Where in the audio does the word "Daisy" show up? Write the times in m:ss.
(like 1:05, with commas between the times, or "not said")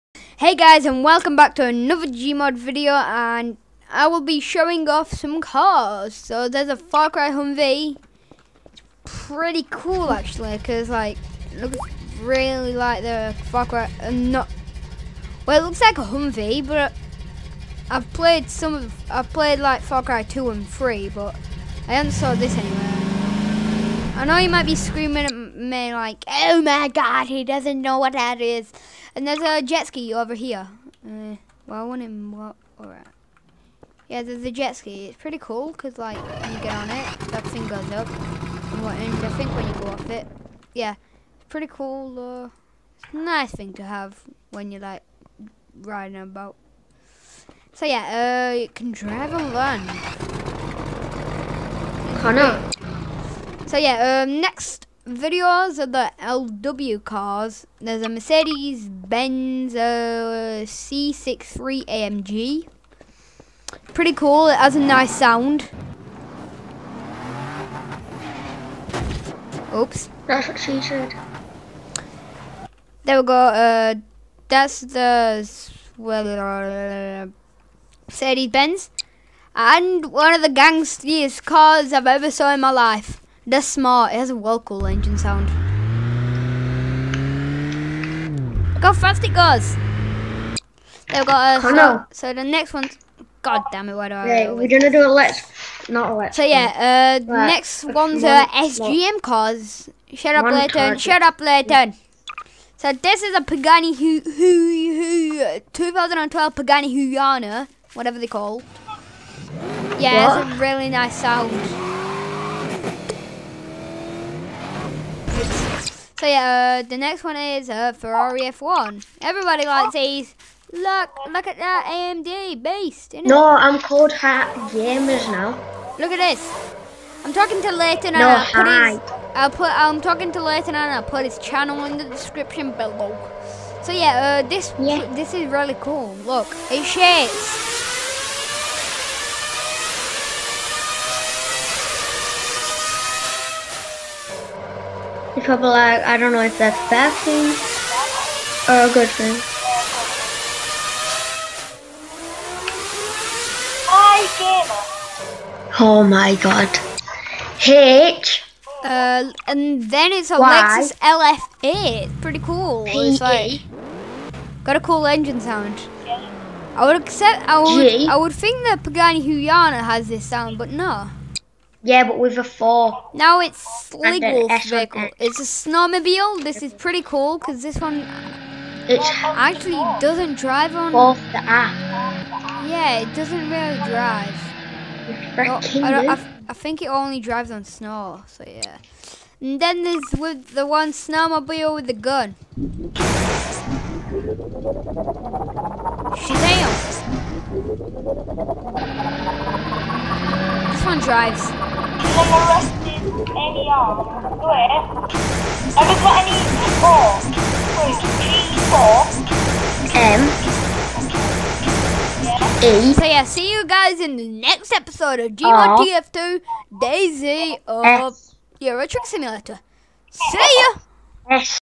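3:36.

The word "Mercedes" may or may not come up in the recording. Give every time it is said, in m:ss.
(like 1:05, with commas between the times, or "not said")
0:58, 1:18.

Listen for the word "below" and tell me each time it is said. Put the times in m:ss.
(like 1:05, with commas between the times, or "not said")
2:12.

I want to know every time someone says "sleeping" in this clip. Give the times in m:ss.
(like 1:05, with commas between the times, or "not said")
not said.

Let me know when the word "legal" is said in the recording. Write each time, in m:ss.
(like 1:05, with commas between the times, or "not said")
2:53.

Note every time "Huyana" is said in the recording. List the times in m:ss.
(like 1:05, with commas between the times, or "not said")
1:46, 2:49.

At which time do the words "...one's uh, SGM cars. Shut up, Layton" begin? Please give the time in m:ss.
1:37.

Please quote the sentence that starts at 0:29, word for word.
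And there's a jet ski over here.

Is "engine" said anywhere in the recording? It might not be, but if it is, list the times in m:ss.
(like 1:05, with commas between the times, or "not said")
1:24, 2:45.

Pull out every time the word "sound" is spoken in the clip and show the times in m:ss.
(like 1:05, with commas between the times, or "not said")
1:05, 1:25, 1:51, 2:45, 2:50.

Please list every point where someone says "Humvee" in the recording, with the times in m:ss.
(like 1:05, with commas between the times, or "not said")
0:07, 0:16.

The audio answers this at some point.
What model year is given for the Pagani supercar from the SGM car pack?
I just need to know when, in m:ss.
1:45.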